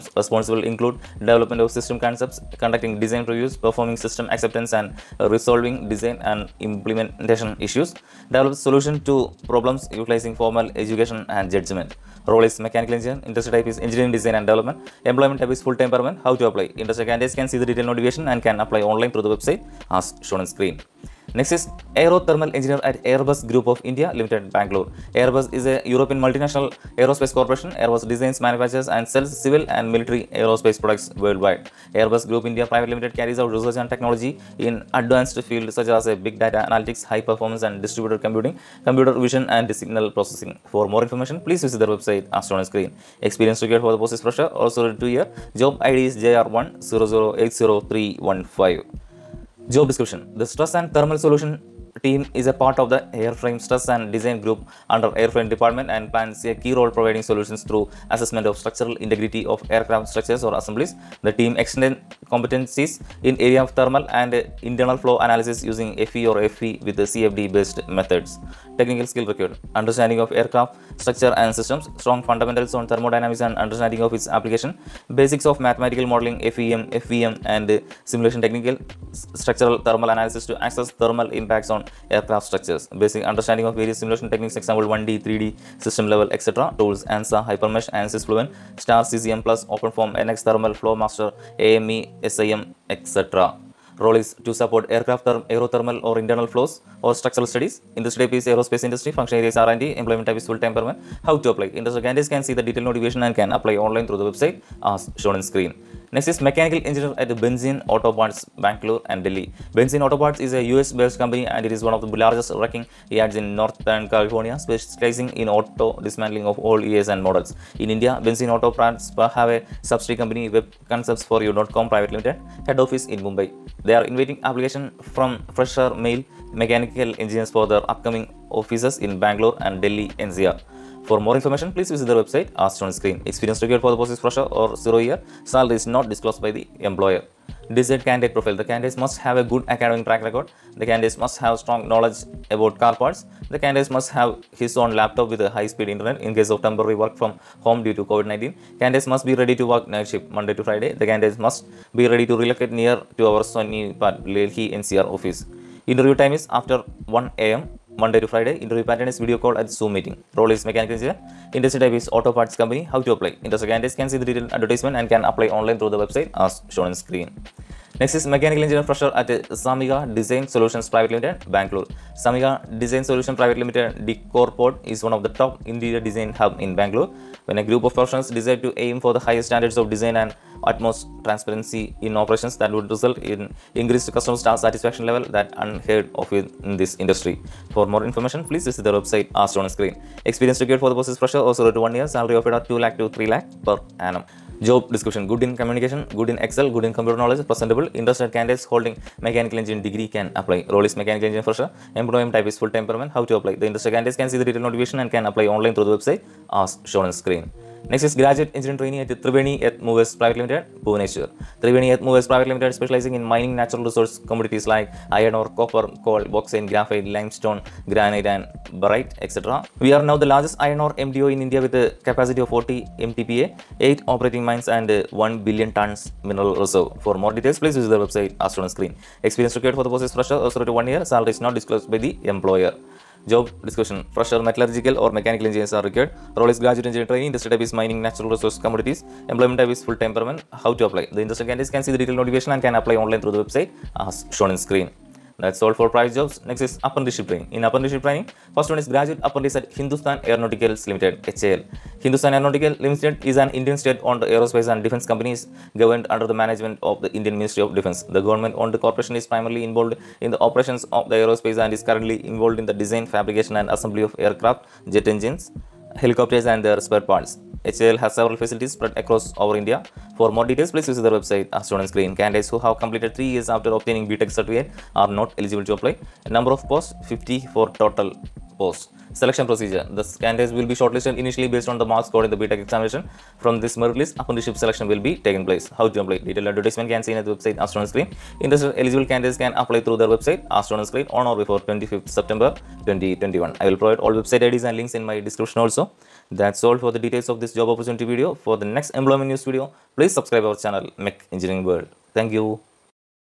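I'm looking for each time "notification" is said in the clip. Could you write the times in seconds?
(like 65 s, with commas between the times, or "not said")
17 s, 102 s, 204 s, 242 s.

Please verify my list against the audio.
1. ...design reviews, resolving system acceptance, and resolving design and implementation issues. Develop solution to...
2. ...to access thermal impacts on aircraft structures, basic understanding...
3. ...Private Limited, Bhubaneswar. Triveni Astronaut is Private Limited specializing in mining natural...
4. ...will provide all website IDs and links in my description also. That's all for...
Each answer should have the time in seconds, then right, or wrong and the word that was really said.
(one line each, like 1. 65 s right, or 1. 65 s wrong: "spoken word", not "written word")
1. 3 s wrong: "performing", not "resolving"
2. 80 s right
3. 210 s wrong: "Earth", not "Astronaut"
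4. 293 s right.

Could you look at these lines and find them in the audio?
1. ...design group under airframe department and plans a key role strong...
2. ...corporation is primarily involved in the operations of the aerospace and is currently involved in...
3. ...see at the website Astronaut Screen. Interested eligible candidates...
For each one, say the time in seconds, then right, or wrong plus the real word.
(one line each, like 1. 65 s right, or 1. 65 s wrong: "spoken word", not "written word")
1. 54 s wrong: "providing", not "strong"
2. 258 s right
3. 287 s right.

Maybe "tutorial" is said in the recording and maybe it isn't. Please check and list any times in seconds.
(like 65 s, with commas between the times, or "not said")
not said.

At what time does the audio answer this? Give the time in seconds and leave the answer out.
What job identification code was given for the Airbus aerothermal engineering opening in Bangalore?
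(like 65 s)
46 s.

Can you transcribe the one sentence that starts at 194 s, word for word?
Job description good in communication, good in Excel, good in computer knowledge, presentable, interested candidates holding mechanical engineering degree can apply.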